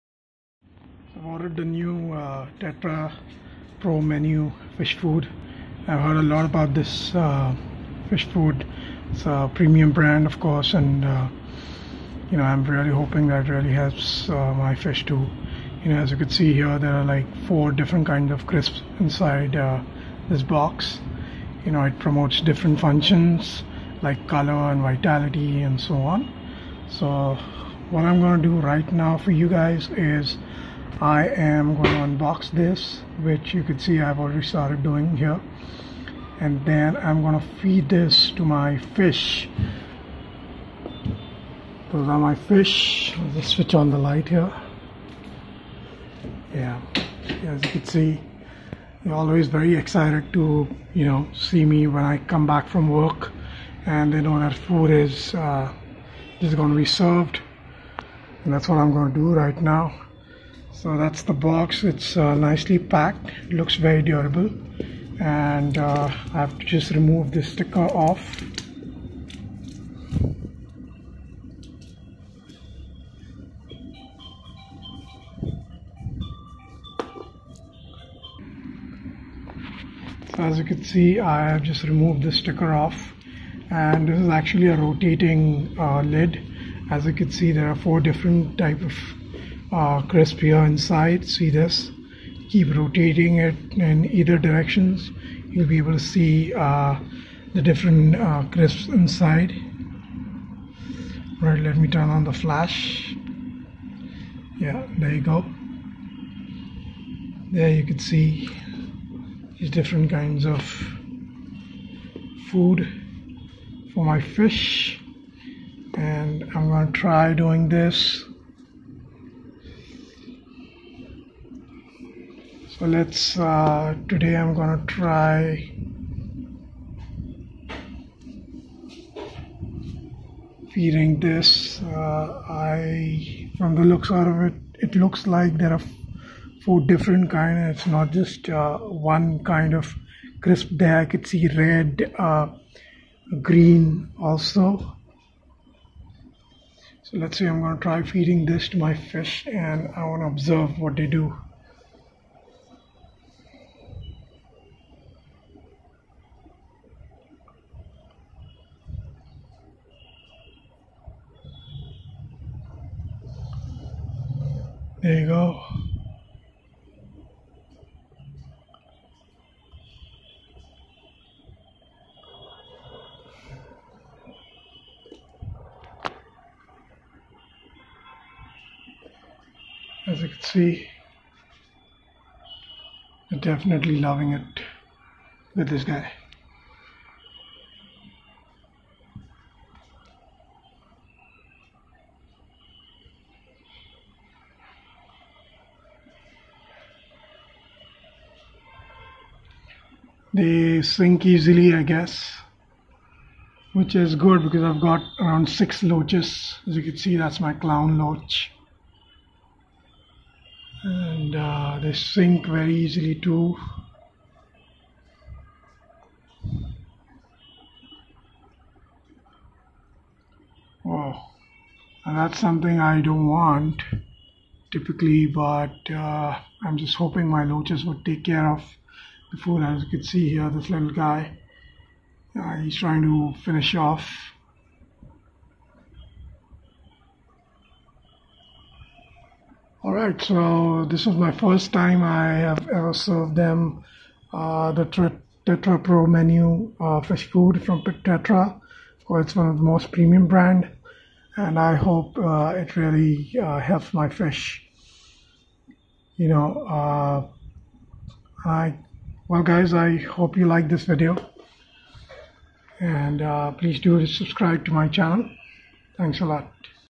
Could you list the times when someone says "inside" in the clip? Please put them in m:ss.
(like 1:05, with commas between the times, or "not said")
0:18, 1:30, 1:38.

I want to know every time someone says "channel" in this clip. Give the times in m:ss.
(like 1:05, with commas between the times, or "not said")
4:24.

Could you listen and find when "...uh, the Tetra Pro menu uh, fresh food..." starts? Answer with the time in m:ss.
4:04.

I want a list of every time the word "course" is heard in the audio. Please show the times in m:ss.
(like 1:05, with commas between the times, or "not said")
0:10, 4:09.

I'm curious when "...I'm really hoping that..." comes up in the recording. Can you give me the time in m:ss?
0:12.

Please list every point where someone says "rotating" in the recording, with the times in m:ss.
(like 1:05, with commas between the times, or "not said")
1:24, 1:32.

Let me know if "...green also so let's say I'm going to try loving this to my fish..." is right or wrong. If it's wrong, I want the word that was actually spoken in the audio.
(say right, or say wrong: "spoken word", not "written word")
wrong: "feeding", not "loving".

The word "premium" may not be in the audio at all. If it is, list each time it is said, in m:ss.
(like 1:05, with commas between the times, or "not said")
0:09, 4:09.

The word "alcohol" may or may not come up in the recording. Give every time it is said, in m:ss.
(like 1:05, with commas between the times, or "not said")
not said.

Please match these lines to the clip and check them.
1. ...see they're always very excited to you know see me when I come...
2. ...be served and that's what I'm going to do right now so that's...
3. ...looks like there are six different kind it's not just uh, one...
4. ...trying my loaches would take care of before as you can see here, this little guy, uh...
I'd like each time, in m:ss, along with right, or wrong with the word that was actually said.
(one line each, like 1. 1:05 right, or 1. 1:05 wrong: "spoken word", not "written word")
1. 0:47 right
2. 0:56 right
3. 2:14 wrong: "four", not "six"
4. 3:46 wrong: "hoping", not "trying".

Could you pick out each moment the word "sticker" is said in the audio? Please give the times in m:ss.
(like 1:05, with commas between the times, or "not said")
1:07, 1:22.